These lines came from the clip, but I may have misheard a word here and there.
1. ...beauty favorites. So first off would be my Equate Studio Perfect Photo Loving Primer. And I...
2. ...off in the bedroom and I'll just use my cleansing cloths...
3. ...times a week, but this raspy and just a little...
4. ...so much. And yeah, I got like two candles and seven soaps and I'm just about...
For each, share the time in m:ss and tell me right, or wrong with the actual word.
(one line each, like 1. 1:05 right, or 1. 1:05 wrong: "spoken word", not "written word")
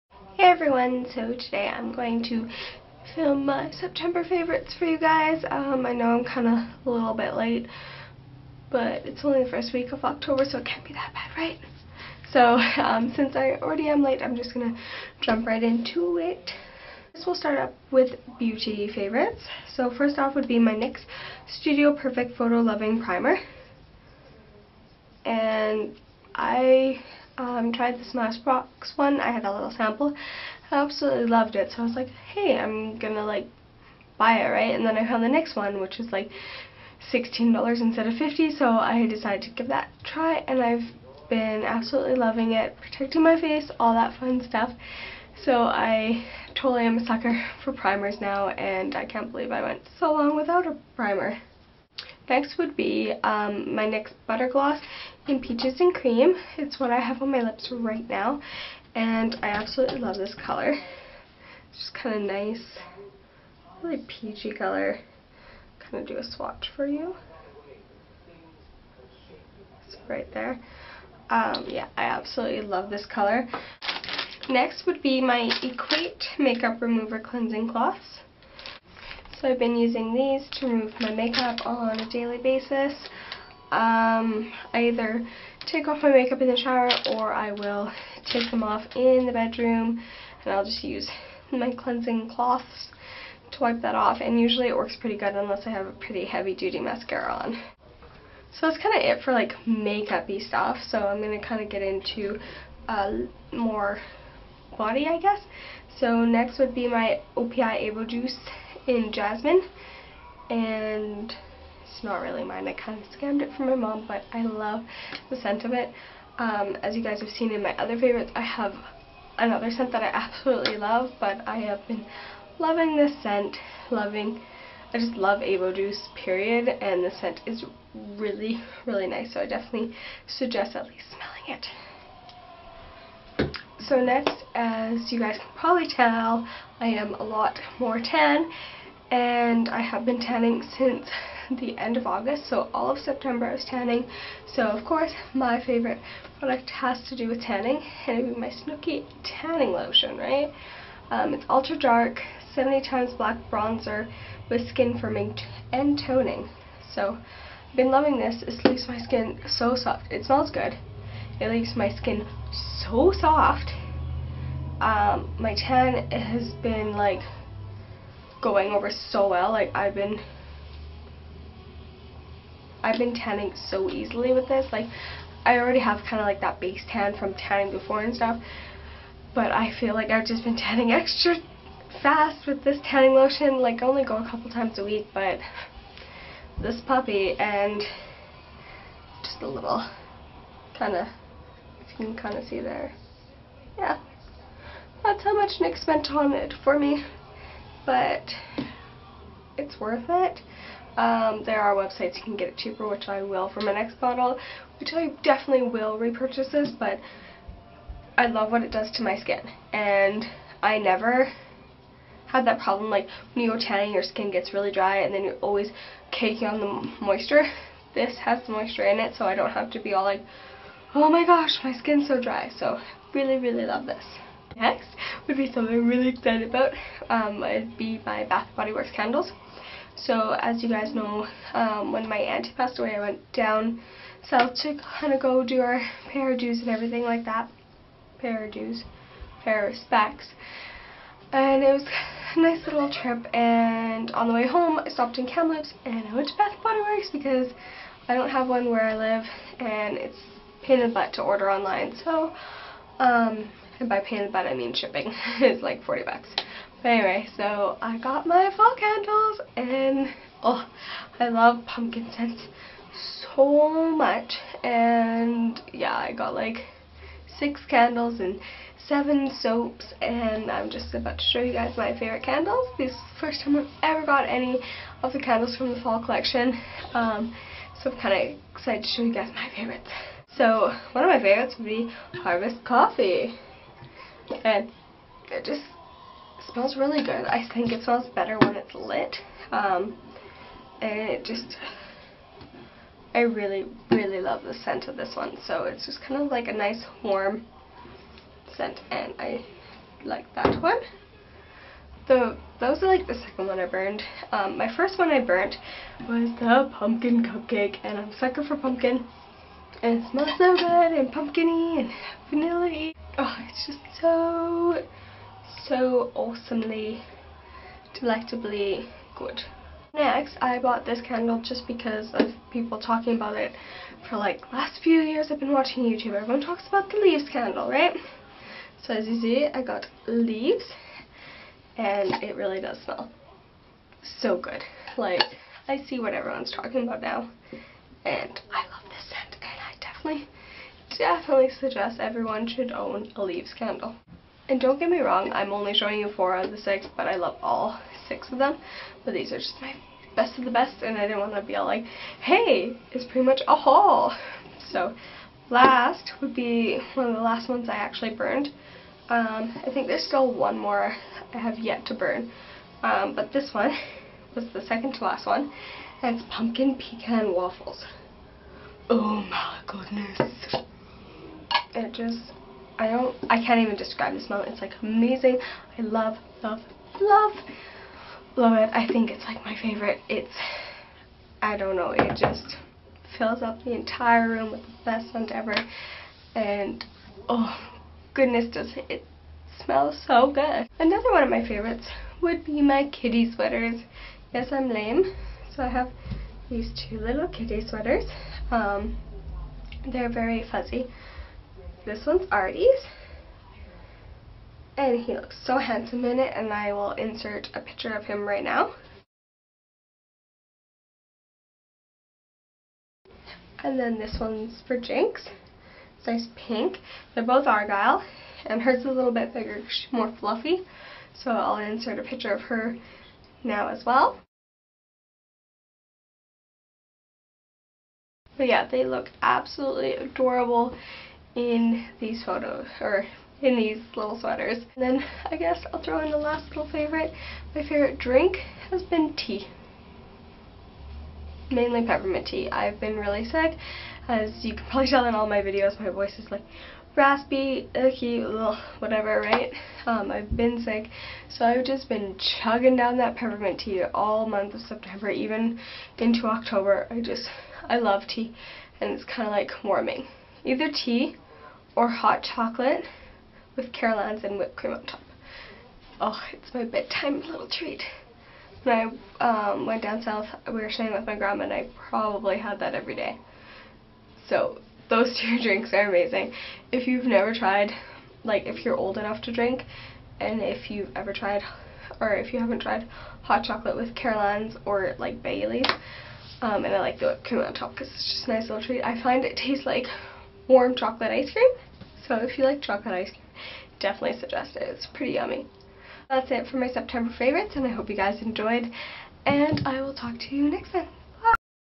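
1. 0:18 wrong: "NYX", not "Equate"
2. 1:28 right
3. 3:04 wrong: "puppy", not "raspy"
4. 4:23 wrong: "six", not "two".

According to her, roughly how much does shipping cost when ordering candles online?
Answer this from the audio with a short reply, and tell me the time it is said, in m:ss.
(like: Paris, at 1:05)
40 bucks, at 4:15.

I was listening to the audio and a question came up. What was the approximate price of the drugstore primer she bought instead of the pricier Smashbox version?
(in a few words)
$16.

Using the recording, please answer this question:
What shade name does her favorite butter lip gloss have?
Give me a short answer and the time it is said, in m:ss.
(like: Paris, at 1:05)
Peaches and Cream, at 0:55.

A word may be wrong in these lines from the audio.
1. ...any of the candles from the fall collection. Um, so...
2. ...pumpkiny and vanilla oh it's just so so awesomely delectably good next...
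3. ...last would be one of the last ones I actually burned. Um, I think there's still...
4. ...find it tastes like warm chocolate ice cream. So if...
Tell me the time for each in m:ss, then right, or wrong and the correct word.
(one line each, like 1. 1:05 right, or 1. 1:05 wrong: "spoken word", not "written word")
1. 4:34 right
2. 5:11 right
3. 5:55 right
4. 8:09 right.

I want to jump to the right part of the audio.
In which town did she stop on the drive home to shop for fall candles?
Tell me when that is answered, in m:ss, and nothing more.
4:05.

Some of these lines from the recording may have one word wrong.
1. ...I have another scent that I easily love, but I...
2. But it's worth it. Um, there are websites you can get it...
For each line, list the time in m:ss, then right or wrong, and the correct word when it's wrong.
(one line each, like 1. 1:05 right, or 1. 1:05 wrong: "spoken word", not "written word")
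1. 1:58 wrong: "absolutely", not "easily"
2. 3:17 right.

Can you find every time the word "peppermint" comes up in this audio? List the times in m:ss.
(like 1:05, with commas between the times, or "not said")
7:21, 7:33.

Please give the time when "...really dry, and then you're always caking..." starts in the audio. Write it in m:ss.
3:34.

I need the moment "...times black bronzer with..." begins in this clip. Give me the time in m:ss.
2:32.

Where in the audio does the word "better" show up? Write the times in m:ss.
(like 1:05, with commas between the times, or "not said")
4:48.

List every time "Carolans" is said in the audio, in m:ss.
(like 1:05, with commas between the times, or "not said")
7:43, 8:03.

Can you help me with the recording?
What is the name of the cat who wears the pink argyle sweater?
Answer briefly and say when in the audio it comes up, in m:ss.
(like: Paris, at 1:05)
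Jinx, at 6:54.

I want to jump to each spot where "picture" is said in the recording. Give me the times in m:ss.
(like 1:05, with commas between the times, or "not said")
6:47, 7:02.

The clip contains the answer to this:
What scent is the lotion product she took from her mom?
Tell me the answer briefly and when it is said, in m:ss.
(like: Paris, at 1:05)
Jasmine, at 1:49.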